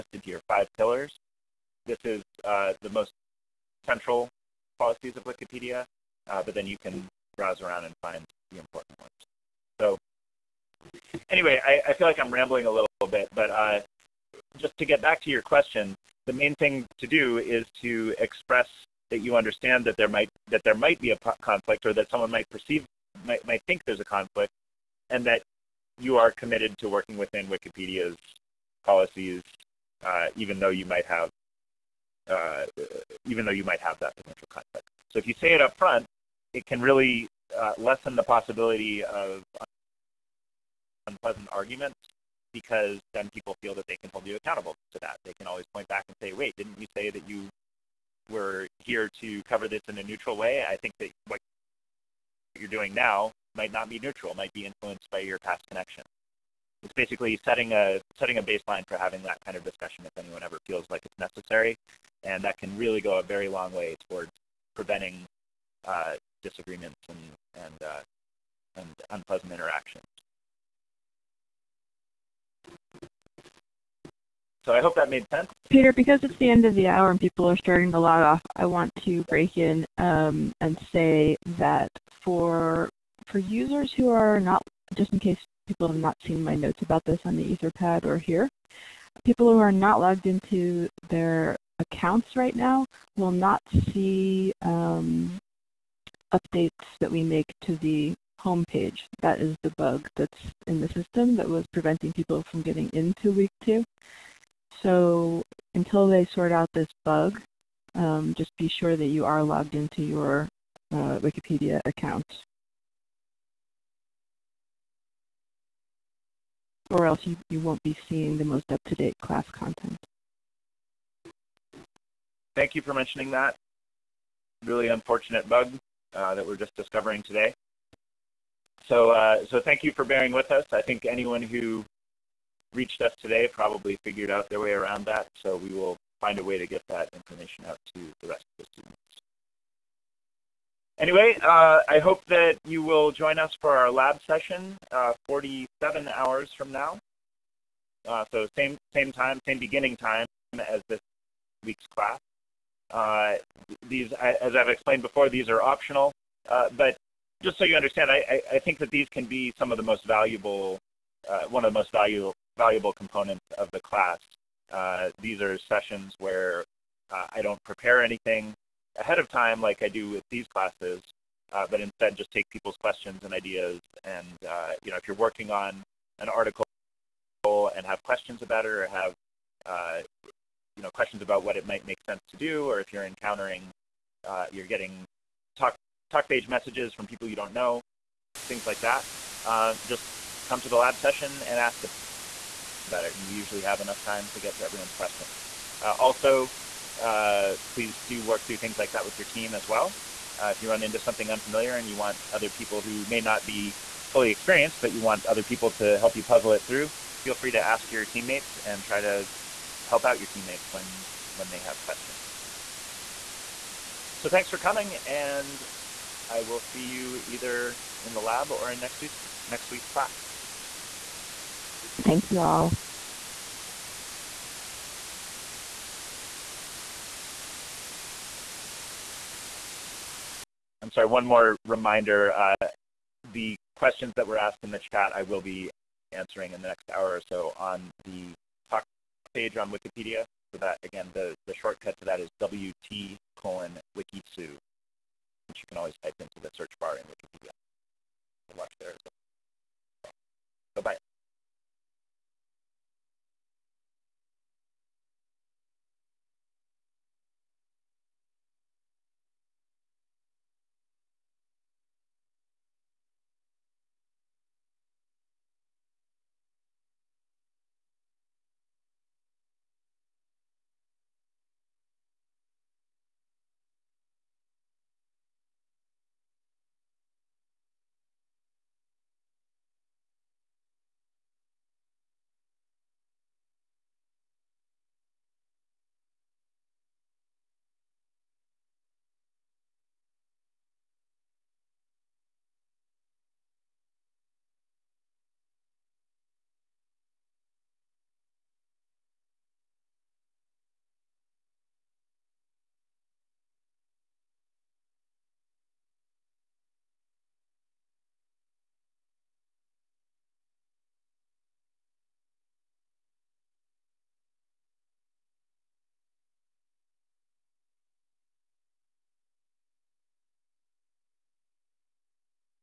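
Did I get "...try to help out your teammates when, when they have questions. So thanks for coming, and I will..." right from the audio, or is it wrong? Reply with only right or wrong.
right.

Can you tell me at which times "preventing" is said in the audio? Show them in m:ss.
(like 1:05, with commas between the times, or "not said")
1:04, 1:41.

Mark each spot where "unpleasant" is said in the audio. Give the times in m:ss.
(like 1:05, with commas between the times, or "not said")
0:41, 1:09.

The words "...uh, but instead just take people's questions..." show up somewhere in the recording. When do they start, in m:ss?
2:51.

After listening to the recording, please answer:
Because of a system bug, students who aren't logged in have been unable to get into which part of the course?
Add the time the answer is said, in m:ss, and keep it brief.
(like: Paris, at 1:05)
Week two, at 1:43.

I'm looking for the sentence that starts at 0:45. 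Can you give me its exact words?
They can always point back and say, wait, didn't you say that you were here to cover this in a neutral way?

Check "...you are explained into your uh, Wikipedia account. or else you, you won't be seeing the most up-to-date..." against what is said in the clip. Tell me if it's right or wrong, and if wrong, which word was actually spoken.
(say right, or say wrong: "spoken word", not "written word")
wrong: "logged", not "explained".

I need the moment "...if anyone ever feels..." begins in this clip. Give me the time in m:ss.
1:00.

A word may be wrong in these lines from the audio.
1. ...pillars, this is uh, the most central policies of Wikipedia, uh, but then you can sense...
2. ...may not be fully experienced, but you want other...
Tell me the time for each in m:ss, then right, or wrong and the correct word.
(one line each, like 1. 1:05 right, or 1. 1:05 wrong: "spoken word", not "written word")
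1. 0:00 wrong: "browse", not "sense"
2. 3:23 right.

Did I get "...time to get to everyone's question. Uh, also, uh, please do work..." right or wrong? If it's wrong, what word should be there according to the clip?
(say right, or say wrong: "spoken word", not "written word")
right.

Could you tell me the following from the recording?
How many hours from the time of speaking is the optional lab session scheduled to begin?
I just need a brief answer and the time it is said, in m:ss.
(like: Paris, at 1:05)
47, at 2:25.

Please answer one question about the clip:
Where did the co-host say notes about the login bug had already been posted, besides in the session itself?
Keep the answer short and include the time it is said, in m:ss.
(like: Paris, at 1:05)
Etherpad, at 1:27.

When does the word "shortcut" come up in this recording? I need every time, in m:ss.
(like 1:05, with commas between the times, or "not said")
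4:01.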